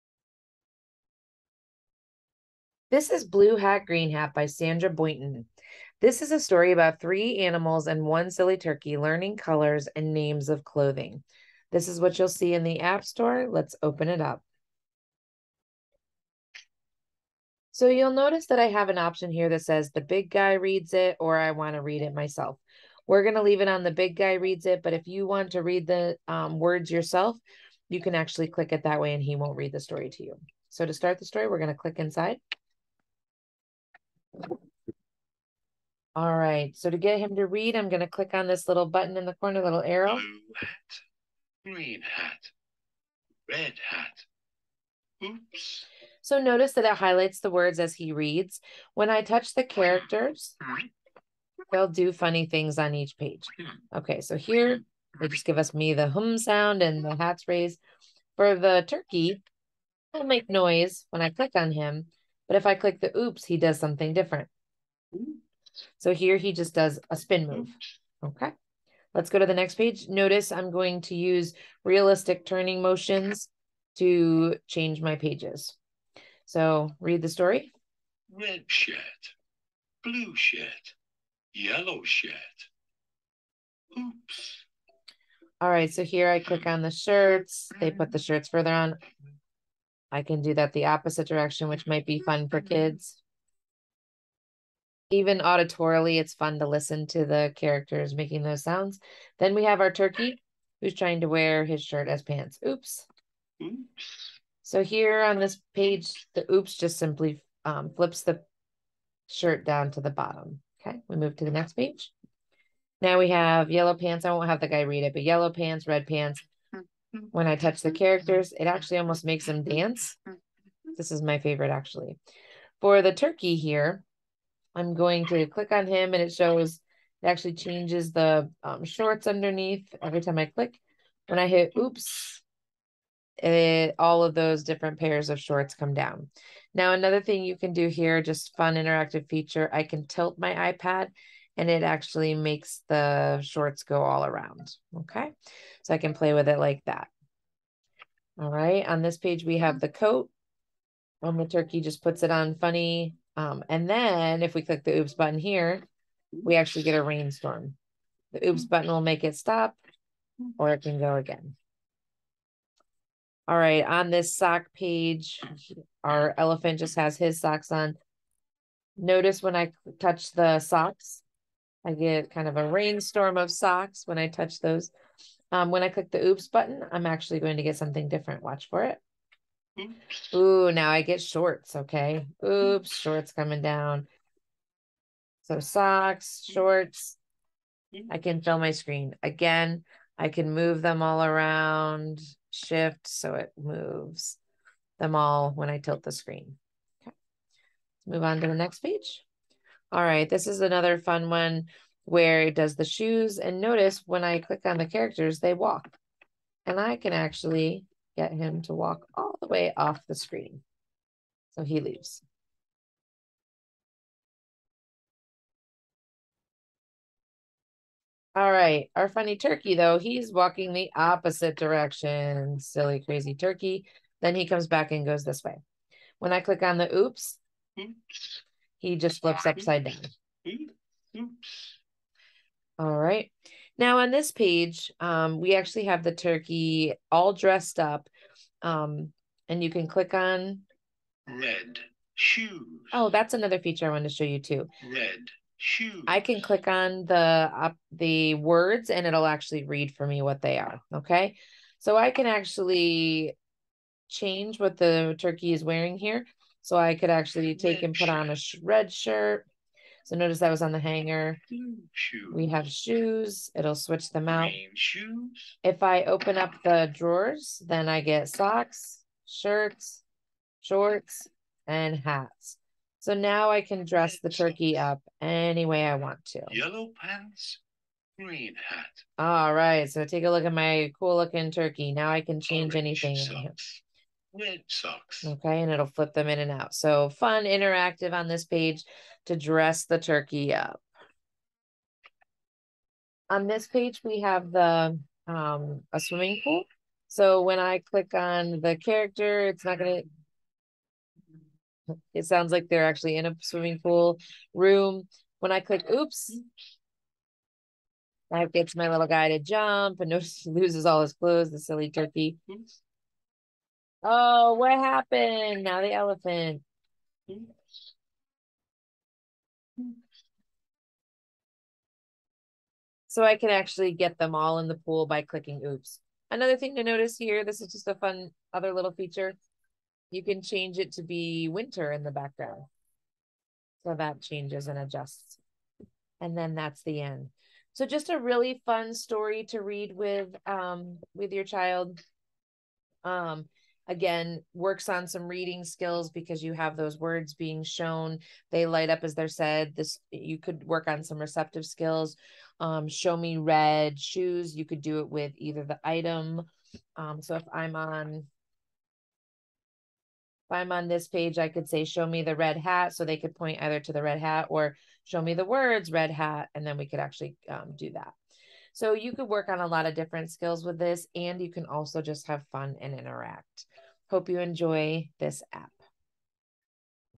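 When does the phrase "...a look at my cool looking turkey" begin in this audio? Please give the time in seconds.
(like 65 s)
280 s.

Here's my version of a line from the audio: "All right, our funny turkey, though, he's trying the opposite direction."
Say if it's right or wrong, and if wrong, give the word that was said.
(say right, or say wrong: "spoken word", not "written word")
wrong: "walking", not "trying".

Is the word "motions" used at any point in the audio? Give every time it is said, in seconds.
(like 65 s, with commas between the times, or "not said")
72 s.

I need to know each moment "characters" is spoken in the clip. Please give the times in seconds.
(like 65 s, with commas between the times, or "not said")
49 s, 97 s, 117 s, 204 s, 298 s.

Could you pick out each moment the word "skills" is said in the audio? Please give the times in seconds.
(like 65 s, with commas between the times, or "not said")
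345 s, 351 s, 370 s.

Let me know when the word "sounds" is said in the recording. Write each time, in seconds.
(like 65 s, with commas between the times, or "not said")
56 s, 98 s, 302 s.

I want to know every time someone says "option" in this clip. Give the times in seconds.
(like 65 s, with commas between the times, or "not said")
18 s.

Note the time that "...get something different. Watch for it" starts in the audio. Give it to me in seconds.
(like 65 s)
177 s.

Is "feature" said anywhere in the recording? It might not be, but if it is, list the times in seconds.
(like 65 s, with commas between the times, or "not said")
139 s, 243 s, 328 s.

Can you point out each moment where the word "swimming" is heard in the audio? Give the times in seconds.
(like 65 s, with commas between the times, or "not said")
295 s, 303 s.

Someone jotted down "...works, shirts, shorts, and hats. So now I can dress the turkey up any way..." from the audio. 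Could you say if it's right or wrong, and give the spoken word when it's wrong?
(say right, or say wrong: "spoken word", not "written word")
wrong: "socks", not "works".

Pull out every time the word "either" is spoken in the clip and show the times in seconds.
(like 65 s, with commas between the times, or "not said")
355 s, 363 s.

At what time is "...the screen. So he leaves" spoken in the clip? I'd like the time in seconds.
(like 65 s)
210 s.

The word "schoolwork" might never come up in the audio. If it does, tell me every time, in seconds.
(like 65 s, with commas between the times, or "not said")
not said.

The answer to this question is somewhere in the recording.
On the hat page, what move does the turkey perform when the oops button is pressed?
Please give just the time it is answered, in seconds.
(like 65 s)
67 s.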